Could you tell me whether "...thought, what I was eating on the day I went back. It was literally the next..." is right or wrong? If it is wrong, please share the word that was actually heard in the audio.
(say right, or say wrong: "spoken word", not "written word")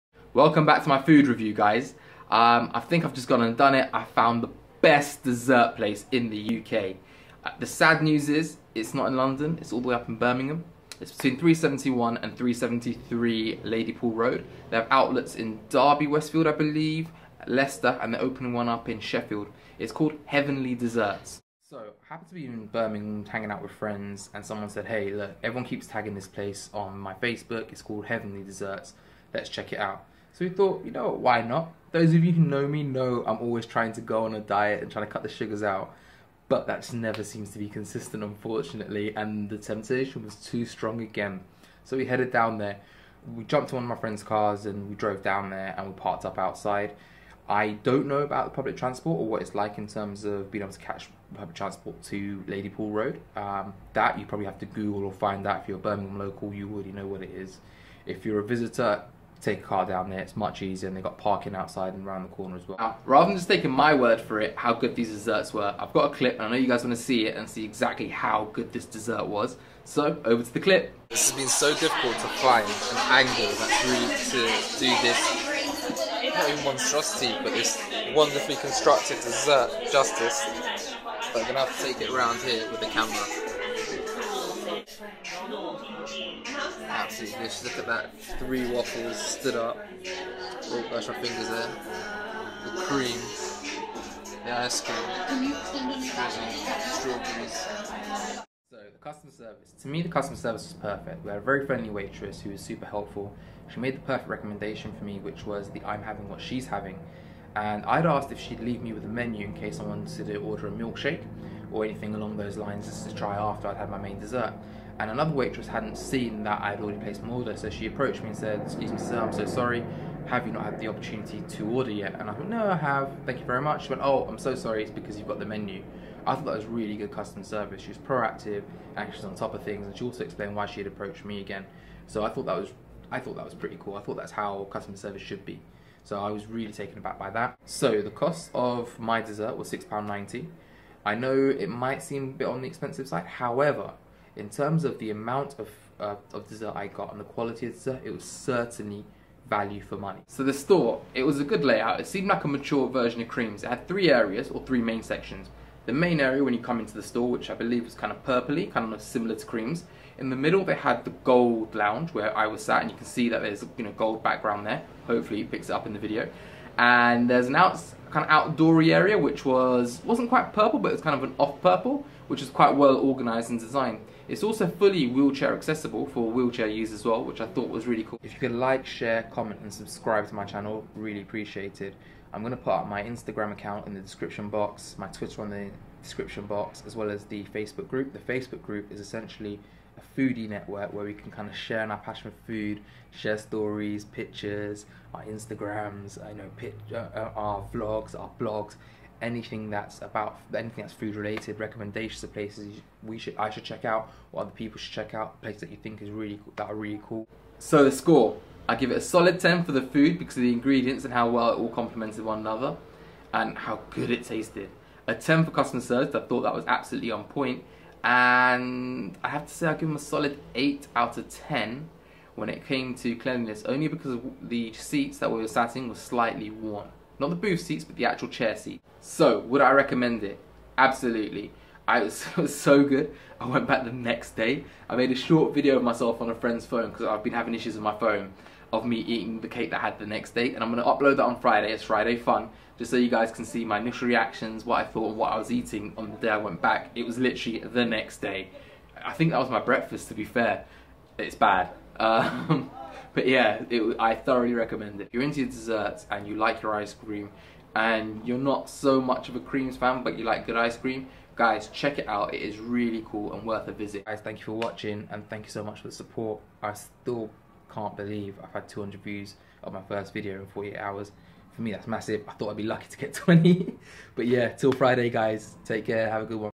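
right.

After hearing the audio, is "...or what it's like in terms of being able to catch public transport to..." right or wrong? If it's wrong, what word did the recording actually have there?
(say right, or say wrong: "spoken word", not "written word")
right.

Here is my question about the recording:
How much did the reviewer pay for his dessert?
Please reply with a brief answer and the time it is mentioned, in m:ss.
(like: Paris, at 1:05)
£6.90, at 2:19.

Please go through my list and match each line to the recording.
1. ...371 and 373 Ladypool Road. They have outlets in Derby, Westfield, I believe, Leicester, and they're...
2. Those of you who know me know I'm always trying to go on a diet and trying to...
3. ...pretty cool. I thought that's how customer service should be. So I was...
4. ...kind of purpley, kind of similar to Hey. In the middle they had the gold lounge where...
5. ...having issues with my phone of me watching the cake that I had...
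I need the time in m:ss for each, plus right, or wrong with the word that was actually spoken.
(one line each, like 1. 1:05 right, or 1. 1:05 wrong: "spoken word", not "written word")
1. 0:11 right
2. 0:31 right
3. 2:13 right
4. 2:37 wrong: "Creams", not "Hey"
5. 3:57 wrong: "eating", not "watching".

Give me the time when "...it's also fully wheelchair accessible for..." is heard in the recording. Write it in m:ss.
2:54.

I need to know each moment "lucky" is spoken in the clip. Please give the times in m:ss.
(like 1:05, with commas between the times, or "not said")
4:32.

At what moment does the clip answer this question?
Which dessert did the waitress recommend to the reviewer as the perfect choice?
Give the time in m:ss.
1:45.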